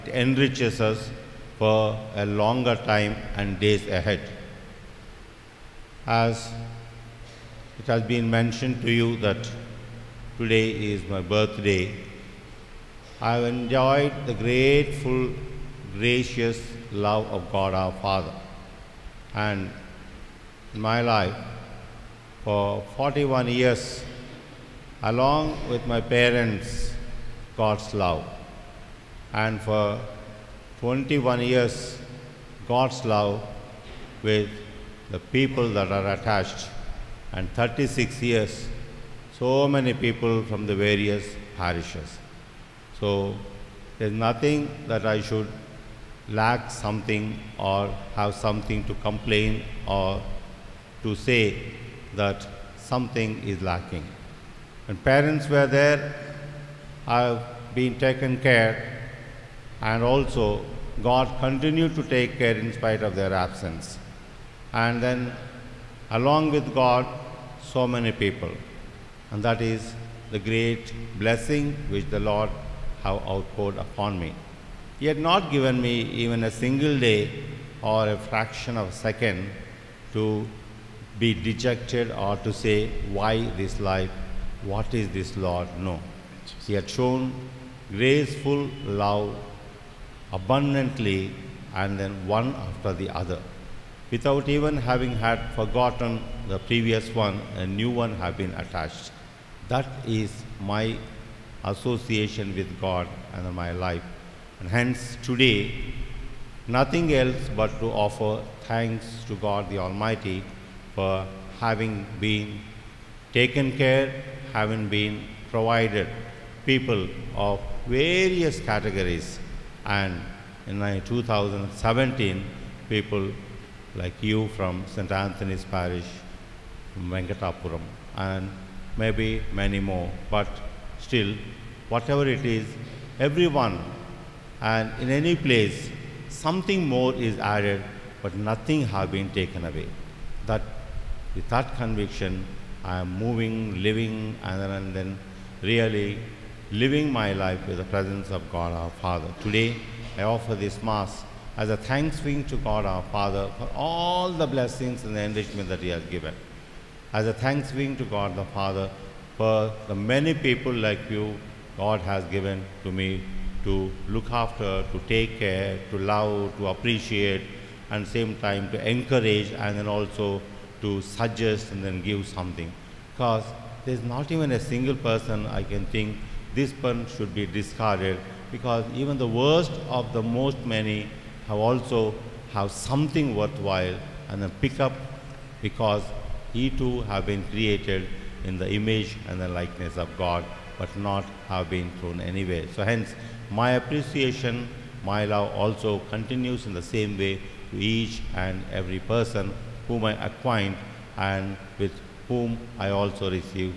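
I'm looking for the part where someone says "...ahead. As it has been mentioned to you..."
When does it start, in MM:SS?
00:03.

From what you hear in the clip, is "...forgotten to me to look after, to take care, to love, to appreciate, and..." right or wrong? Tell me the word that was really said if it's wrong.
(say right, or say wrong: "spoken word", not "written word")
wrong: "given", not "forgotten".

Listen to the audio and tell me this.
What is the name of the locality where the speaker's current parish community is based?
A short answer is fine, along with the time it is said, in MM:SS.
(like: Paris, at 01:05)
Venkatapuram, at 02:06.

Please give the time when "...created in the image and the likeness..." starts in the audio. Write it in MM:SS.
03:07.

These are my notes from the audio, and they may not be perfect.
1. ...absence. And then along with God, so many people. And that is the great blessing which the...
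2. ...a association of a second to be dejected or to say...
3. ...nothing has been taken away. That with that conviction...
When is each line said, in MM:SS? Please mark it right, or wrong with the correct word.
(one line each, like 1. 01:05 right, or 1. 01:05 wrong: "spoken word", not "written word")
1. 01:03 right
2. 01:18 wrong: "fraction", not "association"
3. 02:18 right.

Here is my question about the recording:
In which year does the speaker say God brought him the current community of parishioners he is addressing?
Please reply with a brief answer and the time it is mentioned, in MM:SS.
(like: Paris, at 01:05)
2017, at 02:01.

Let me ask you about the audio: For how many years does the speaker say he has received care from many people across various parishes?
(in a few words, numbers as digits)
36 years.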